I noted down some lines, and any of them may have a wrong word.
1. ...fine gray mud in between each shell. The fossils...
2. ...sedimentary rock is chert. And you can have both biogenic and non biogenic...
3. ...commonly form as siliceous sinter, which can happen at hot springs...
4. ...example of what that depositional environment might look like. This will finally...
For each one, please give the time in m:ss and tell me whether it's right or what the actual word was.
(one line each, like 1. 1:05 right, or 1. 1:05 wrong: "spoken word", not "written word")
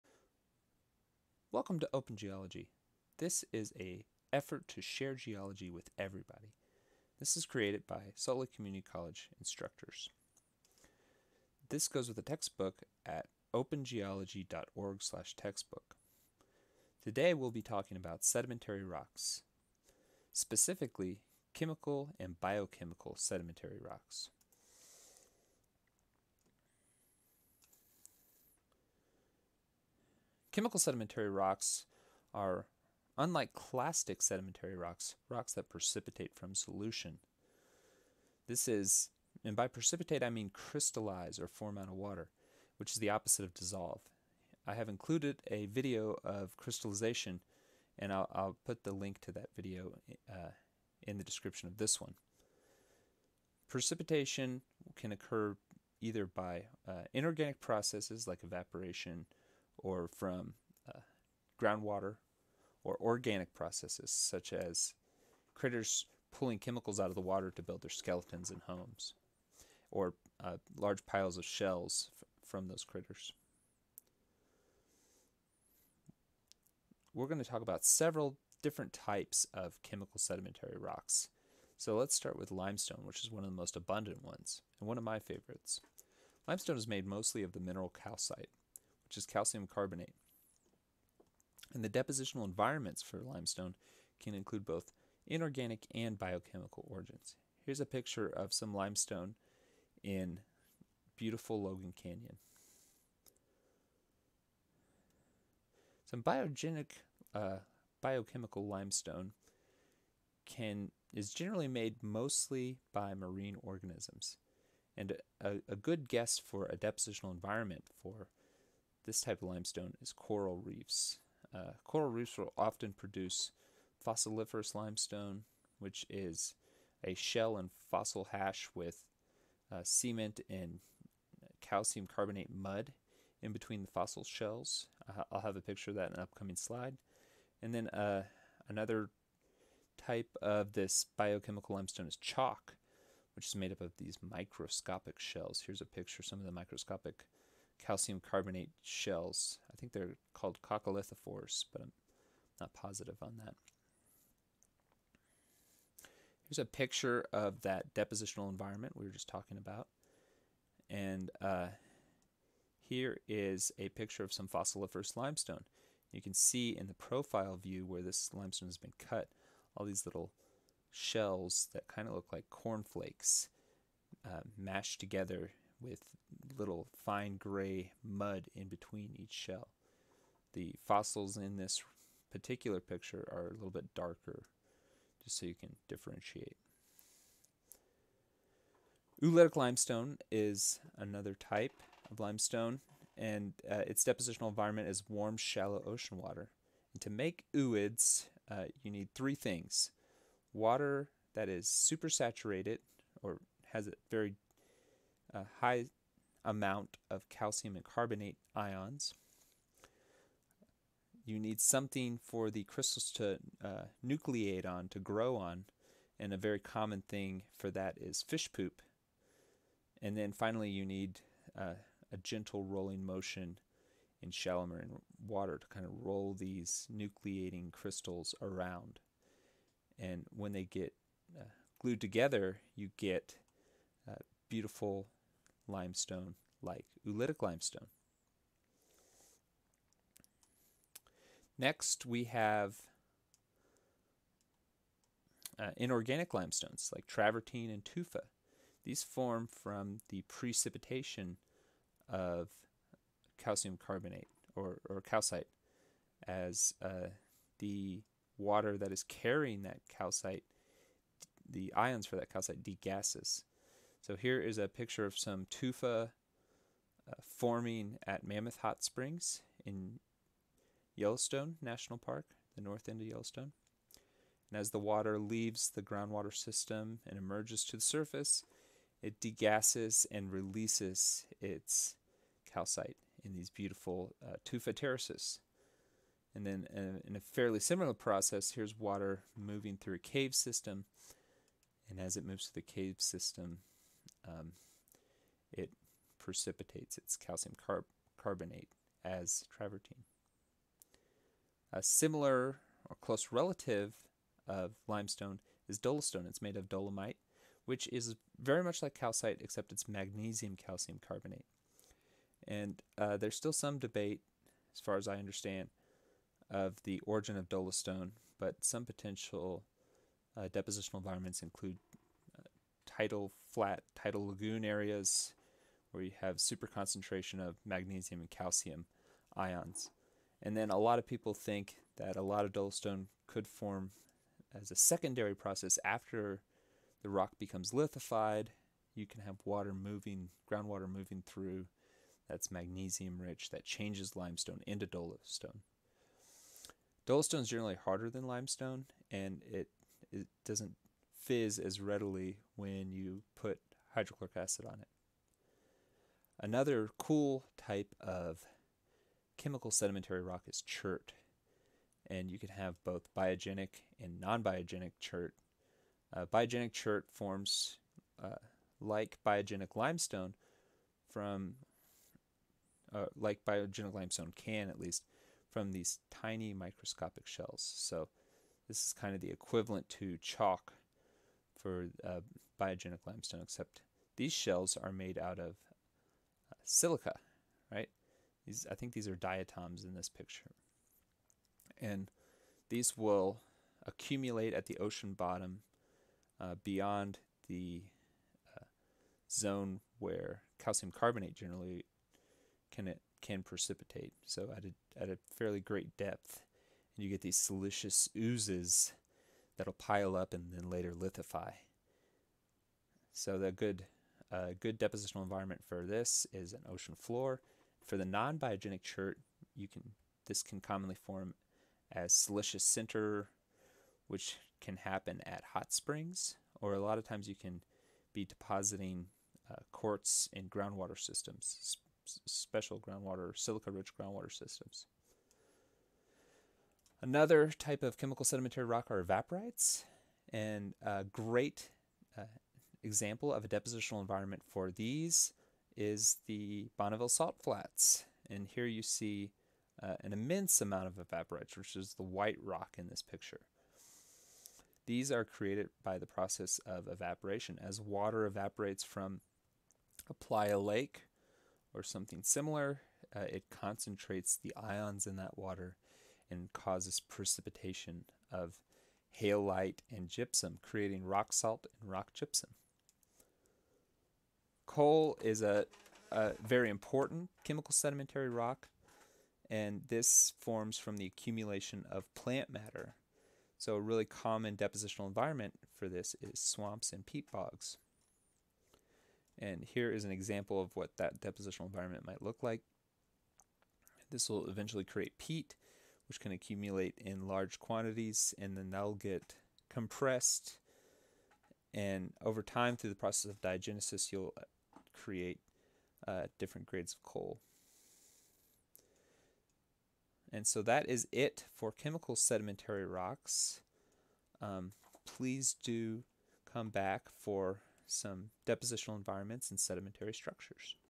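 1. 2:57 right
2. 5:59 right
3. 7:00 right
4. 8:10 wrong: "eventually", not "finally".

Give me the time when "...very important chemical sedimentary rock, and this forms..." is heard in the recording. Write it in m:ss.
7:56.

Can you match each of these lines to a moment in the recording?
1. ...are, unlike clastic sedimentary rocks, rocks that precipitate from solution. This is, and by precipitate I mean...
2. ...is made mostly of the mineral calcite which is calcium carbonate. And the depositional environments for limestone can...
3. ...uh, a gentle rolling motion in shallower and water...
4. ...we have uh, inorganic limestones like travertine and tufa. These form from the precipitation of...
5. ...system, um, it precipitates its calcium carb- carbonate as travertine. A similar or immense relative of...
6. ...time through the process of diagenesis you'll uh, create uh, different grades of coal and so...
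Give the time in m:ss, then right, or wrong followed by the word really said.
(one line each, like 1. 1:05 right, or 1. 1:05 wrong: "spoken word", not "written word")
1. 0:32 right
2. 1:26 right
3. 3:41 right
4. 4:02 right
5. 4:52 wrong: "close", not "immense"
6. 8:22 right.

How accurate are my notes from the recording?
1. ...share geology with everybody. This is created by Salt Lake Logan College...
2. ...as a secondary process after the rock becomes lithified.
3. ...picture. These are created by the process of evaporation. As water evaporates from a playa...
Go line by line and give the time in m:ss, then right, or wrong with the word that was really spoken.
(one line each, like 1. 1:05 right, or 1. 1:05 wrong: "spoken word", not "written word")
1. 0:04 wrong: "Community", not "Logan"
2. 5:34 right
3. 7:33 right.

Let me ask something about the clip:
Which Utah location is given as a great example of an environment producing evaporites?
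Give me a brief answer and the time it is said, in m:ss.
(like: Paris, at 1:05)
Bonneville Salt Flats, at 7:26.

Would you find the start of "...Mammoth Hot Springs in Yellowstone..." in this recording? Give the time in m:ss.
4:28.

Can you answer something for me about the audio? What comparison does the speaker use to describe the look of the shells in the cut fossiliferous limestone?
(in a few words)
cornflakes.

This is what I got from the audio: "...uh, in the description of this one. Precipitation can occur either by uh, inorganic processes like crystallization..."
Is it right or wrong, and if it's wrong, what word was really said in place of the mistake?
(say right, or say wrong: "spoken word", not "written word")
wrong: "evaporation", not "crystallization".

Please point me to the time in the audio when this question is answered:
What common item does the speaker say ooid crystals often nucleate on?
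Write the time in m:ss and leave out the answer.
3:38.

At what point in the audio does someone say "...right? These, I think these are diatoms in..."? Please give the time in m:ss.
6:27.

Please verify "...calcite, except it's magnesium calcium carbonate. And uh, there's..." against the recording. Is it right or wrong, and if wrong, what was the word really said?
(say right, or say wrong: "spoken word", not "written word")
right.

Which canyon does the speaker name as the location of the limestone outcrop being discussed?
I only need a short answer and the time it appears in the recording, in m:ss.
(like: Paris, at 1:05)
Logan Canyon, at 1:41.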